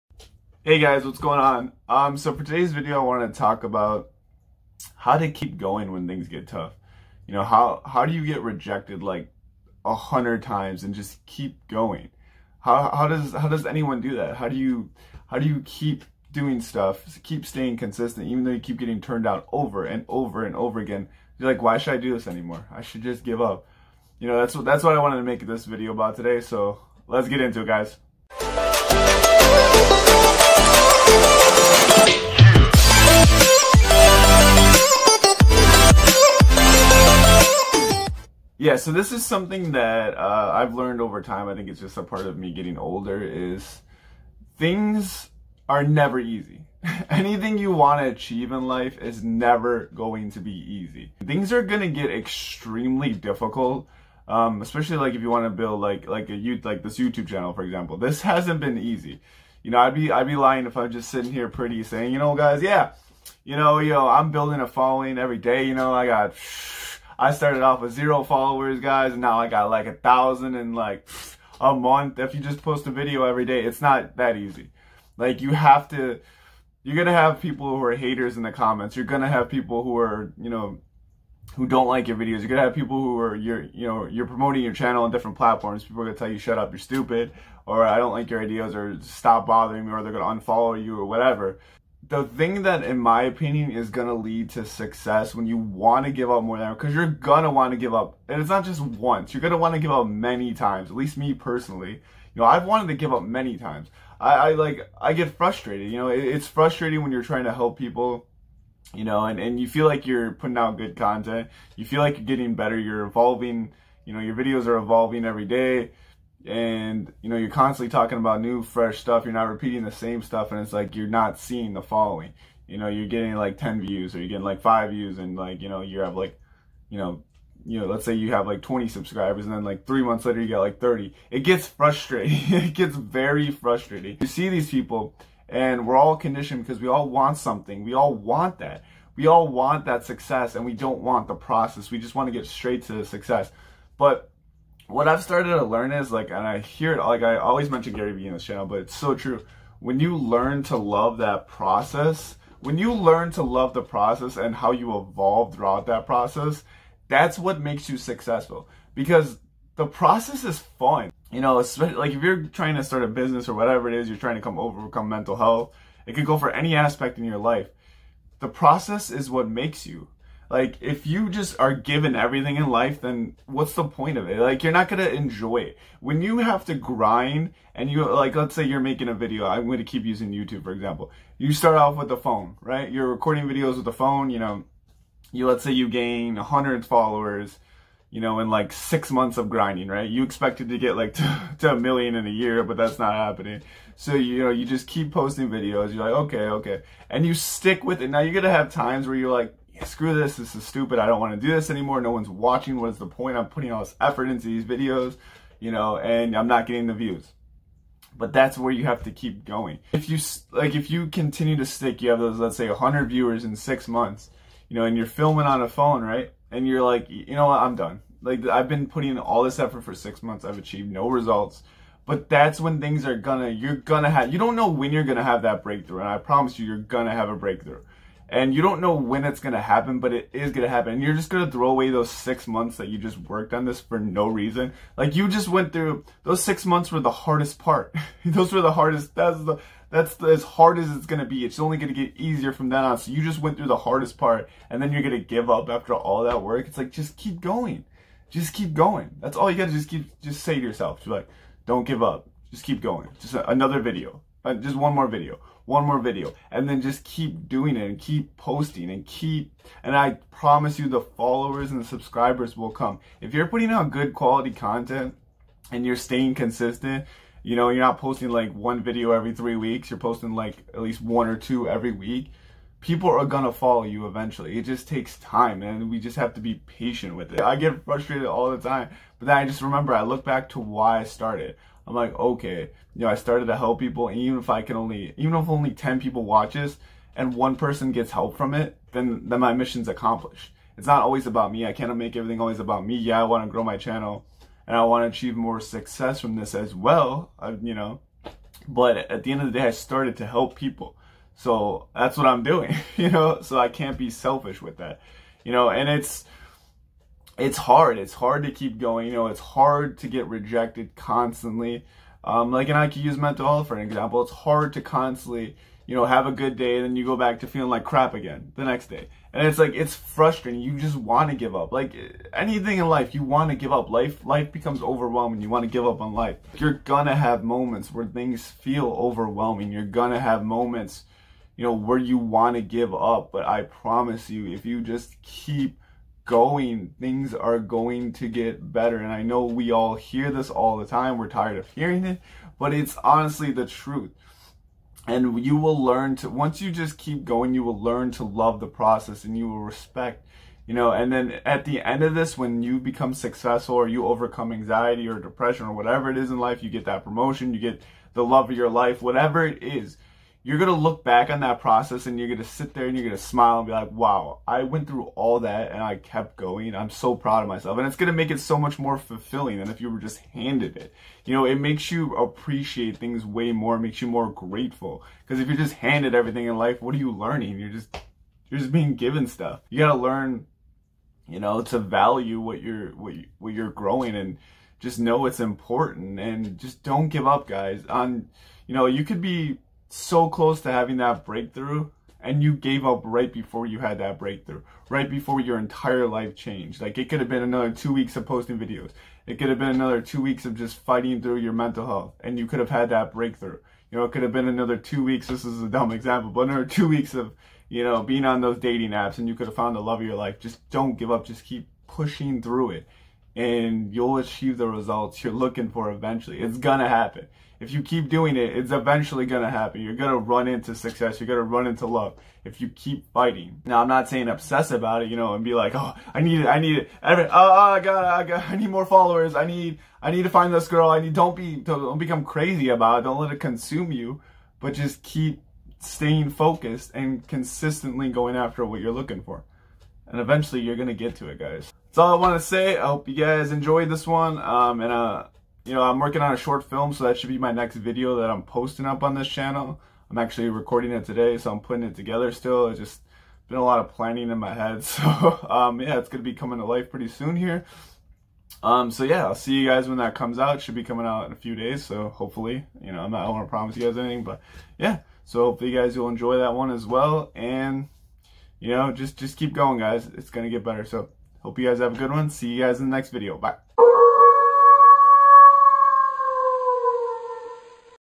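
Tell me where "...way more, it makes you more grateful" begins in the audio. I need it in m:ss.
6:13.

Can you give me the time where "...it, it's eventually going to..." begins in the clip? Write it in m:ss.
6:58.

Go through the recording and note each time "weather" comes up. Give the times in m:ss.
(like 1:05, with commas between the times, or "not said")
not said.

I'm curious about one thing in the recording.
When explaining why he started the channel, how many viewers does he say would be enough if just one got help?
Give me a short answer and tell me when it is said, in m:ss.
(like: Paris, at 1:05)
10, at 4:45.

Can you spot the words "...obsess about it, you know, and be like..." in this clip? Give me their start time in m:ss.
7:04.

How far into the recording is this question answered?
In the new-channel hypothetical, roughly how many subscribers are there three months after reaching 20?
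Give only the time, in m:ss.
2:10.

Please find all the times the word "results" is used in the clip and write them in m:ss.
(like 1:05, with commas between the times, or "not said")
3:41, 6:54.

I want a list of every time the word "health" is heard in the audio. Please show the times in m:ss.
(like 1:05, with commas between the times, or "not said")
2:45, 5:13, 6:41.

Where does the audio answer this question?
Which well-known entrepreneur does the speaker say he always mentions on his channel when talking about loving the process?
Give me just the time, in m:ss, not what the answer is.
2:27.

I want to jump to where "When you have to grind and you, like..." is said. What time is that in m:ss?
2:56.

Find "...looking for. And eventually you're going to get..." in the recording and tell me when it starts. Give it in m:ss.
7:18.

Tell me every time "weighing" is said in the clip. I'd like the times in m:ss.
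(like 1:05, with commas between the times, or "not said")
not said.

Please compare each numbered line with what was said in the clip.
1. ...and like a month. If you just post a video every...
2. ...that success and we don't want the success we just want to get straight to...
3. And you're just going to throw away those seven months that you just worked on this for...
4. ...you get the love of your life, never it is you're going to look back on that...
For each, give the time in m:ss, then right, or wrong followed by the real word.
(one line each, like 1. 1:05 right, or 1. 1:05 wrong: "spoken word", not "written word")
1. 1:10 right
2. 2:19 wrong: "process", not "success"
3. 3:50 wrong: "six", not "seven"
4. 5:57 wrong: "whatever", not "never".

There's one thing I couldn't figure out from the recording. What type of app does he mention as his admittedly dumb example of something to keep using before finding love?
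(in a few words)
dating apps.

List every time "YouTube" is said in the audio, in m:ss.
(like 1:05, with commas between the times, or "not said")
0:56, 3:00.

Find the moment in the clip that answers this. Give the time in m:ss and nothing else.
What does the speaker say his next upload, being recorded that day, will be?
7:26.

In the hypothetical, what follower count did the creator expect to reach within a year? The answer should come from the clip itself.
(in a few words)
a million.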